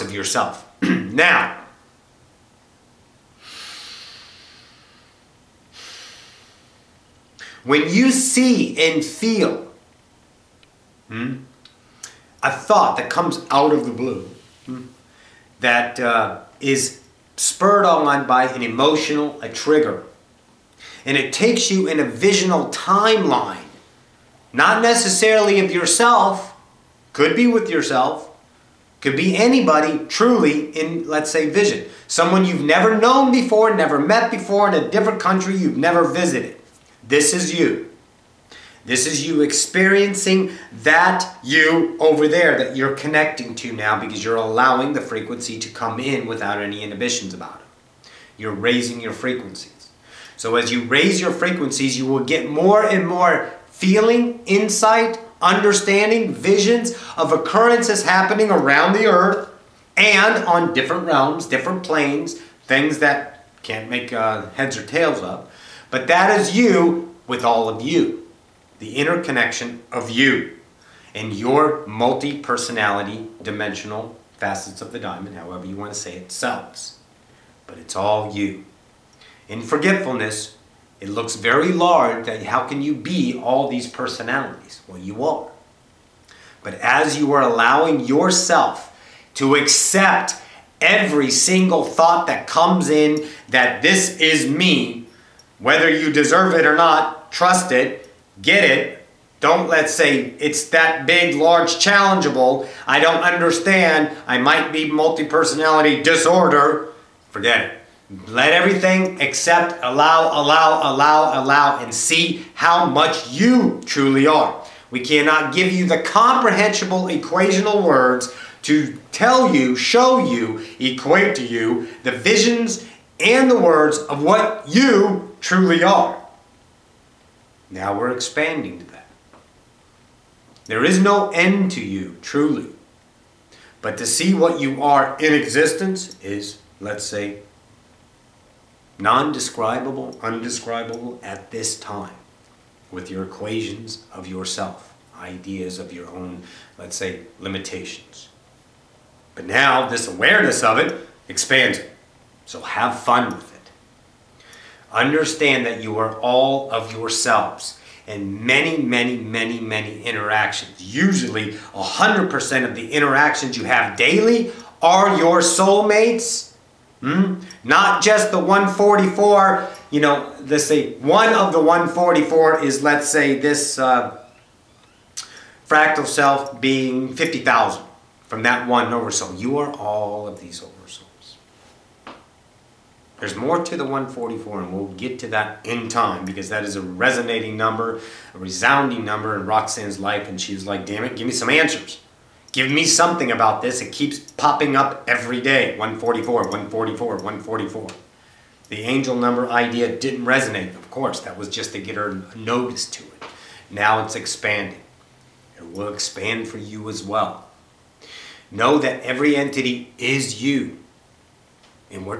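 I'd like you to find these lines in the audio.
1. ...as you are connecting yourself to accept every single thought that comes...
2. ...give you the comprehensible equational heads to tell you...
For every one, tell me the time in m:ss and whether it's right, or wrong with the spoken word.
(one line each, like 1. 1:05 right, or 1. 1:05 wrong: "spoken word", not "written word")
1. 1:26 wrong: "allowing", not "connecting"
2. 1:55 wrong: "words", not "heads".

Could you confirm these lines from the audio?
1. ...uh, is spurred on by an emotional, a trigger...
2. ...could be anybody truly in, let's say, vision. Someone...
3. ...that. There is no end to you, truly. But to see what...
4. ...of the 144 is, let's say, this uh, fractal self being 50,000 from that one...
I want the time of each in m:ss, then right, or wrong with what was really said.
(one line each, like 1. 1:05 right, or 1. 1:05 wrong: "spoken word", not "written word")
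1. 0:15 right
2. 0:28 right
3. 2:08 right
4. 2:51 right.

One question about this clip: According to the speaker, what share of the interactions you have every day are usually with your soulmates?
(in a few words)
100%.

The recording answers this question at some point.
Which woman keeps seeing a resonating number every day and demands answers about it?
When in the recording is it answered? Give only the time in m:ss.
3:09.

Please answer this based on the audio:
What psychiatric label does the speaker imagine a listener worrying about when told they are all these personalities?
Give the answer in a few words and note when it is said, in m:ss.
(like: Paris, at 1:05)
multi personality disorder, at 1:44.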